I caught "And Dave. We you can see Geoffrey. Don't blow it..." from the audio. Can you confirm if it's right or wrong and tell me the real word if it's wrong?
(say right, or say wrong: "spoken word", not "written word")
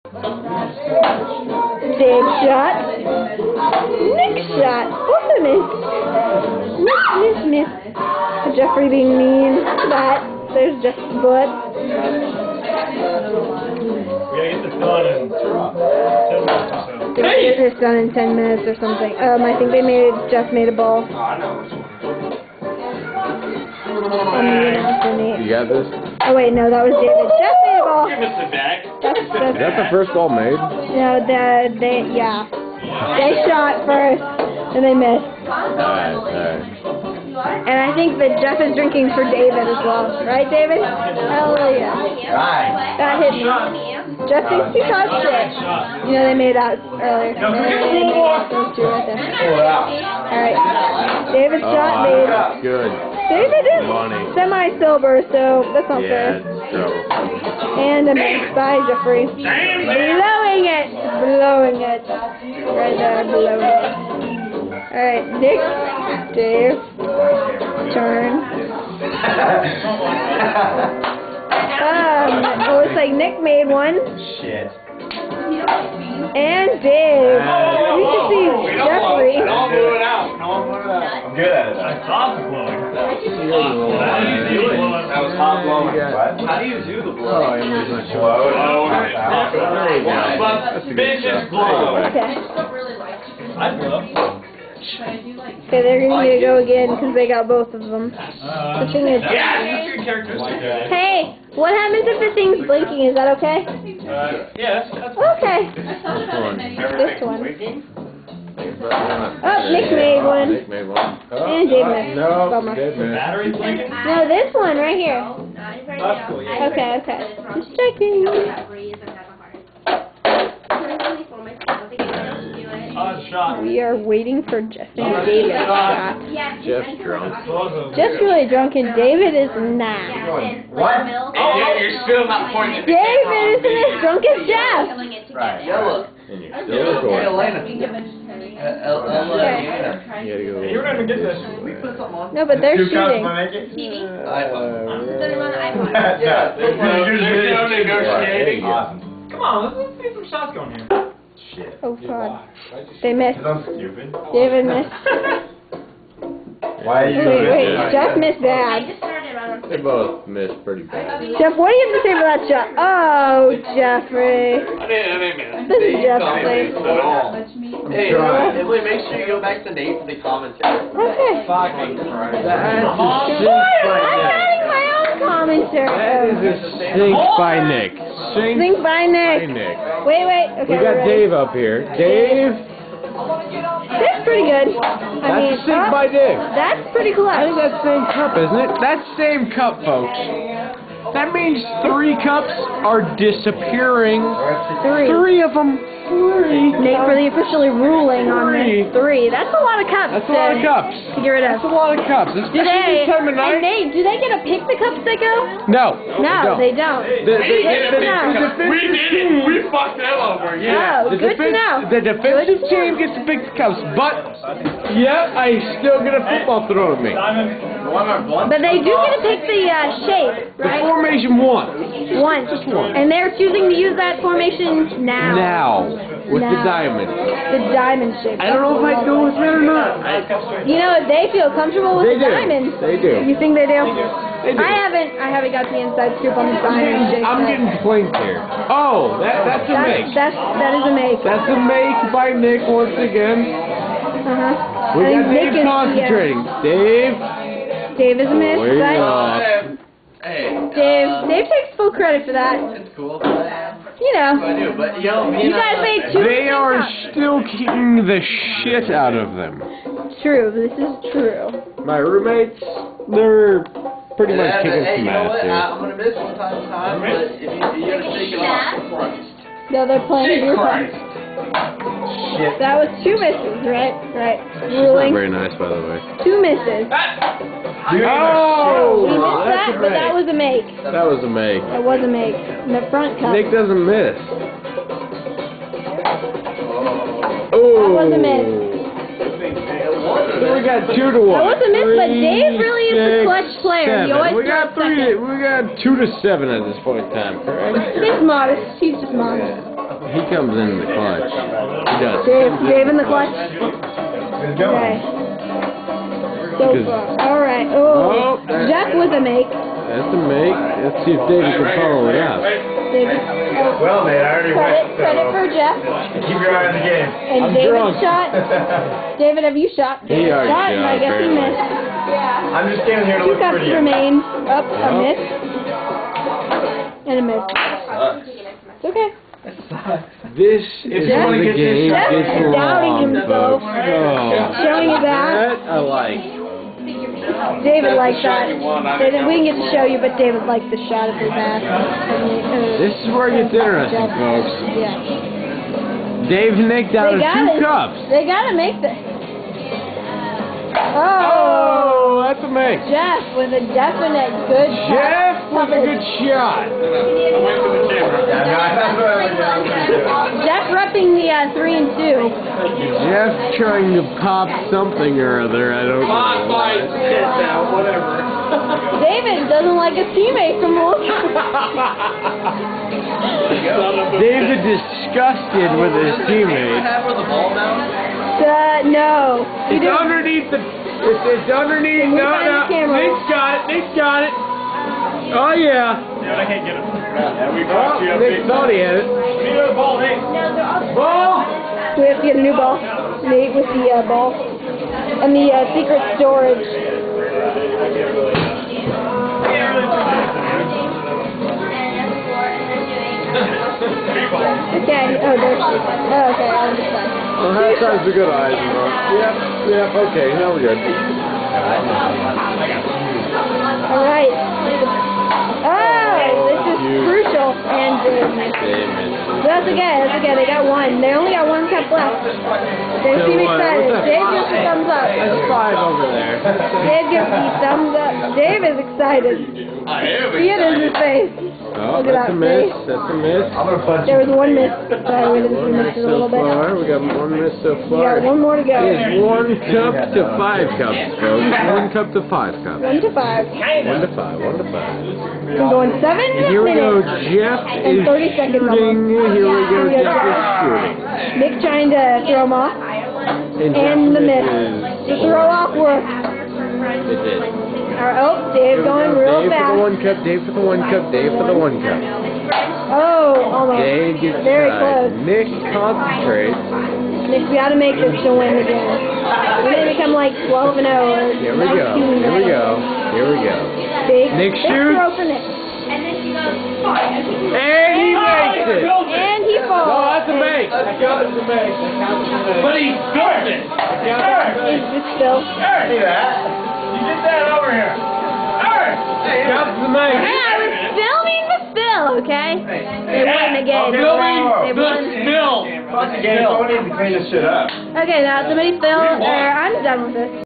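right.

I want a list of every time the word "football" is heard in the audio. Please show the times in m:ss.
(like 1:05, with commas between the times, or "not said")
3:36.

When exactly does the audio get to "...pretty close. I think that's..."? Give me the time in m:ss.
3:06.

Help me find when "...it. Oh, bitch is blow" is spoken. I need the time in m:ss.
1:28.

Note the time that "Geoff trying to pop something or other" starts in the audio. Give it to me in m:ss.
6:03.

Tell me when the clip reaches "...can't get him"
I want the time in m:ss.
6:26.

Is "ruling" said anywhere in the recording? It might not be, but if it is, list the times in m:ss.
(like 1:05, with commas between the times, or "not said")
3:17, 4:34.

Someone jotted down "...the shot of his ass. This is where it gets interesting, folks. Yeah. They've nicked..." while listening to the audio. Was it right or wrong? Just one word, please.
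right.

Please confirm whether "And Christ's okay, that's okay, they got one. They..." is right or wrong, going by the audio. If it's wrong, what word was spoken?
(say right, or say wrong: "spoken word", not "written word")
wrong: "That", not "Christ".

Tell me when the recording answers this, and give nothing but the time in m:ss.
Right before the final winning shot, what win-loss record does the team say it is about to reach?
7:50.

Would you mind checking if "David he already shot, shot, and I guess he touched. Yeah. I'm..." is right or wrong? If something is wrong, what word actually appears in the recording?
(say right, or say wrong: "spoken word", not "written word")
wrong: "missed", not "touched".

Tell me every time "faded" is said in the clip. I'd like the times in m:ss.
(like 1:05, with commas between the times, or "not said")
not said.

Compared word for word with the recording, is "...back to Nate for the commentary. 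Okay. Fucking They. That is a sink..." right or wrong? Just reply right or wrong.
wrong.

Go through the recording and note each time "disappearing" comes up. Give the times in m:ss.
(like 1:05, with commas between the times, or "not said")
3:13.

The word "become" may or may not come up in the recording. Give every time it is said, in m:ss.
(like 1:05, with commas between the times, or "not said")
7:49.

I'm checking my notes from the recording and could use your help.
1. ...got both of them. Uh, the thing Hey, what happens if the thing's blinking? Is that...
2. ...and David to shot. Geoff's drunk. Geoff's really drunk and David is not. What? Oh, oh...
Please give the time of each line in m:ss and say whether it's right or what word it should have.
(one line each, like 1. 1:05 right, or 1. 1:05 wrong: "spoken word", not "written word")
1. 1:37 right
2. 2:05 right.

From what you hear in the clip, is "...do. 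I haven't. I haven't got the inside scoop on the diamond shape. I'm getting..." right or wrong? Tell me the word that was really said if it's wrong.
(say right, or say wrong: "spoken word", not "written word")
right.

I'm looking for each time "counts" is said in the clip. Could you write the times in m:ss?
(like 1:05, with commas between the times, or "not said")
8:00, 8:09.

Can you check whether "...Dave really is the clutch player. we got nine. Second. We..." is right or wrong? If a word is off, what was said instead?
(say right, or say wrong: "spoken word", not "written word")
wrong: "three", not "nine".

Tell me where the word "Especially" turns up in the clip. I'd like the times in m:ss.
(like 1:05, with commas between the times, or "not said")
3:22.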